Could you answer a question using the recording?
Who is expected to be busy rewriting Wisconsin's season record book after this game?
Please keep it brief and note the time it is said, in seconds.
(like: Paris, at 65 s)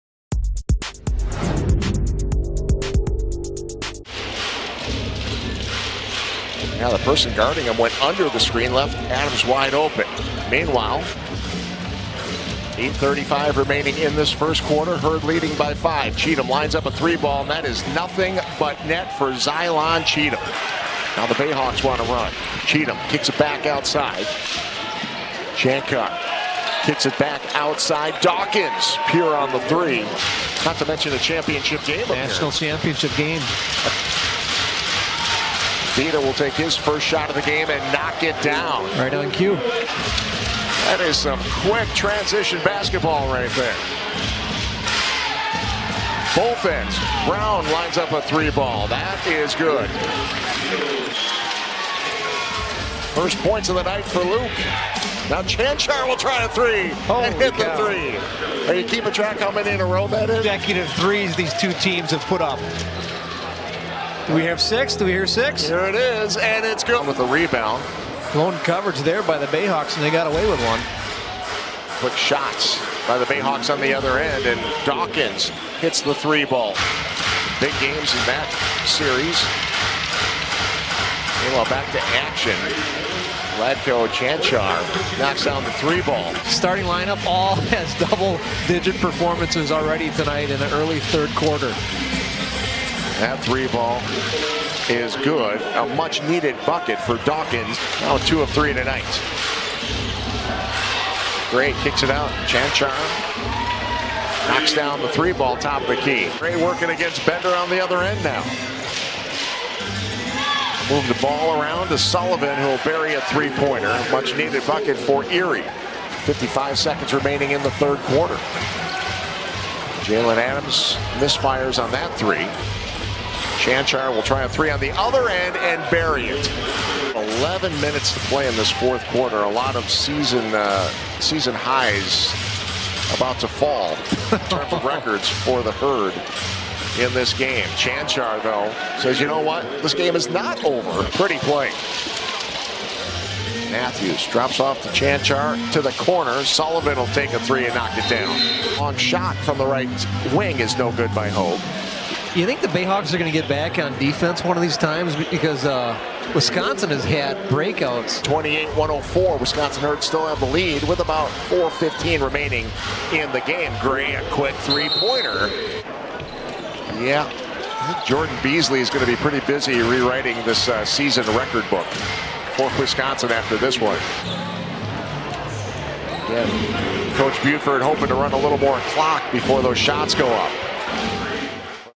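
Jordan Beasley, at 168 s.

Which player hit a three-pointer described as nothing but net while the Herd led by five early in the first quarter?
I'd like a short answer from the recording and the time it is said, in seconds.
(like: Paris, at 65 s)
Zylan Cheatham, at 19 s.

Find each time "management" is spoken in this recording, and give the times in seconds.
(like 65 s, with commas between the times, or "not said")
not said.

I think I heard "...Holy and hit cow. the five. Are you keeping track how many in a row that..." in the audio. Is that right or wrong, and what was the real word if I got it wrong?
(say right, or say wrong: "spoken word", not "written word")
wrong: "three", not "five".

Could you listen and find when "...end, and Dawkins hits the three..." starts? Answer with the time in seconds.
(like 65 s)
74 s.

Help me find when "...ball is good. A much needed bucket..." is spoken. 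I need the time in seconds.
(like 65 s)
93 s.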